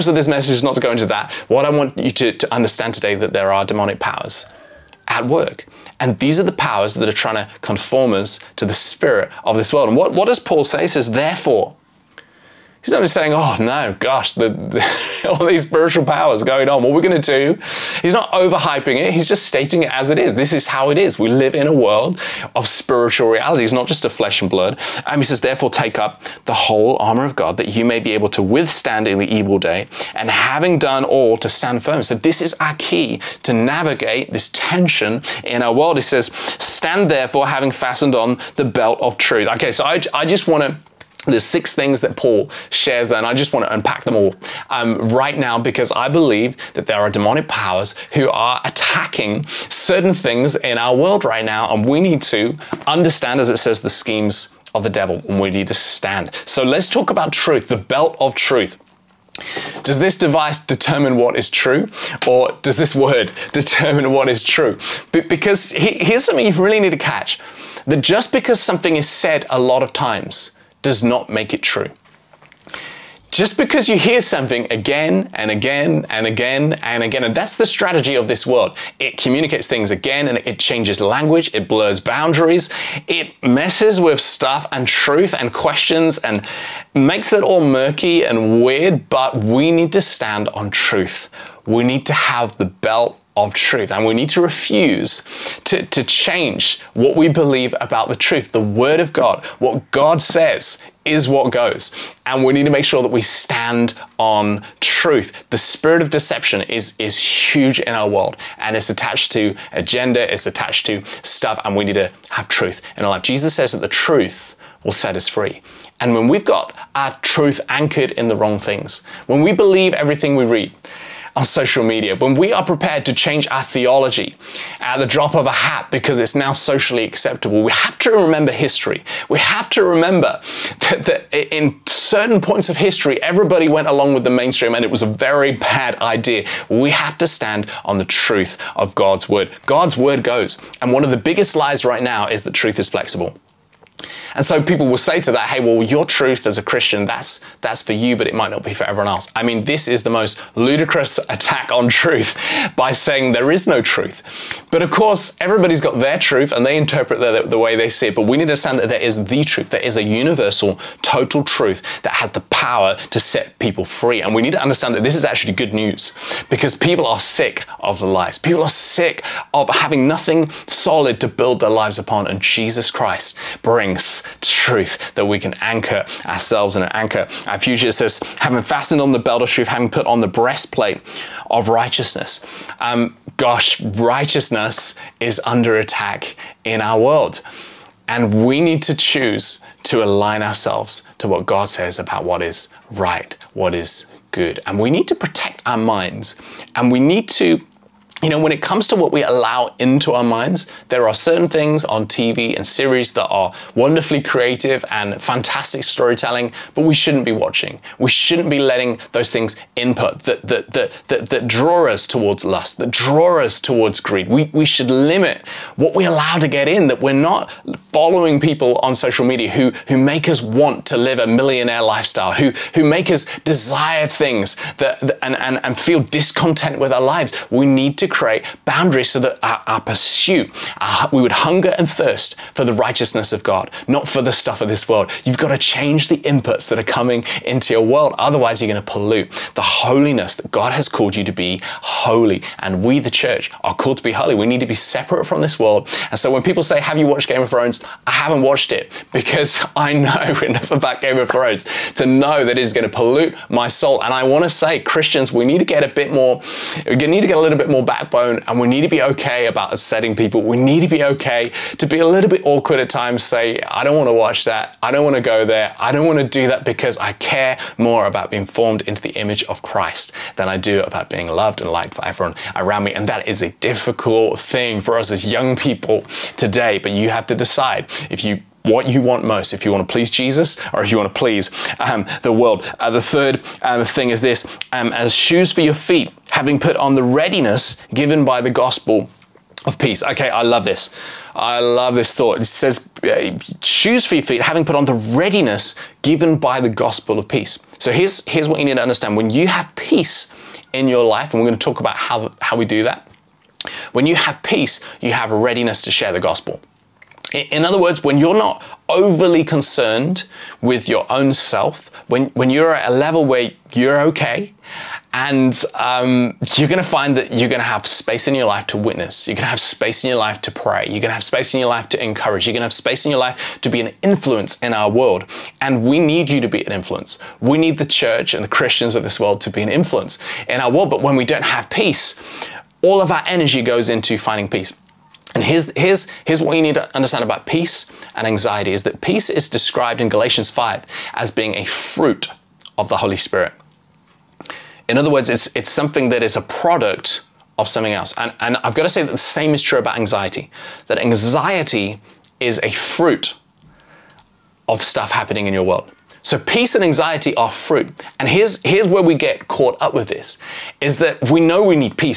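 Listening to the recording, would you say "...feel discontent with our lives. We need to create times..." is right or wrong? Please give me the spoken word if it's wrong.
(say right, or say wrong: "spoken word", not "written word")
wrong: "boundaries", not "times".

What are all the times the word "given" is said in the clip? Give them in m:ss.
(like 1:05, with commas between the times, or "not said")
4:47, 4:56.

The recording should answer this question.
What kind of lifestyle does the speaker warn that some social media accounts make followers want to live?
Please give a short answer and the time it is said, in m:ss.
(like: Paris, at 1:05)
Millionaire lifestyle, at 3:41.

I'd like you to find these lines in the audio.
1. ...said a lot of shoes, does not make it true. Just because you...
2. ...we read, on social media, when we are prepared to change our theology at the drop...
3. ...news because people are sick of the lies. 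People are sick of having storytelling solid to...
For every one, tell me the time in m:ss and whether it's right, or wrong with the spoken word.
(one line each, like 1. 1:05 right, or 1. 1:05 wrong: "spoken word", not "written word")
1. 1:09 wrong: "times", not "shoes"
2. 2:00 right
3. 2:45 wrong: "nothing", not "storytelling".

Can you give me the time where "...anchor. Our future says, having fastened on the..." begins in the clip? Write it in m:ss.
2:56.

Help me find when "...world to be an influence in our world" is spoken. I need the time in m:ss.
5:29.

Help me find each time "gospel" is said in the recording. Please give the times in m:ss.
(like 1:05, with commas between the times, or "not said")
4:48, 4:56, 5:06.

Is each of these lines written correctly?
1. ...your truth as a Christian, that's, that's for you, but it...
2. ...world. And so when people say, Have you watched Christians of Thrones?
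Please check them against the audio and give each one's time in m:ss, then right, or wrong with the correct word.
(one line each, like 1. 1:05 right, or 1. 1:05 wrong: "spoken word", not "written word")
1. 2:25 right
2. 4:05 wrong: "Game", not "Christians".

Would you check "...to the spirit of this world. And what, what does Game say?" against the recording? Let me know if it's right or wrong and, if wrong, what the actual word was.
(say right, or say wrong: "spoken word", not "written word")
wrong: "Paul", not "Game".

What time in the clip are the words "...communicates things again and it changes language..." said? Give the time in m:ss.
1:19.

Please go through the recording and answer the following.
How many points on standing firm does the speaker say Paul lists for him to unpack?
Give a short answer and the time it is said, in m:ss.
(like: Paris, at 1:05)
6, at 0:41.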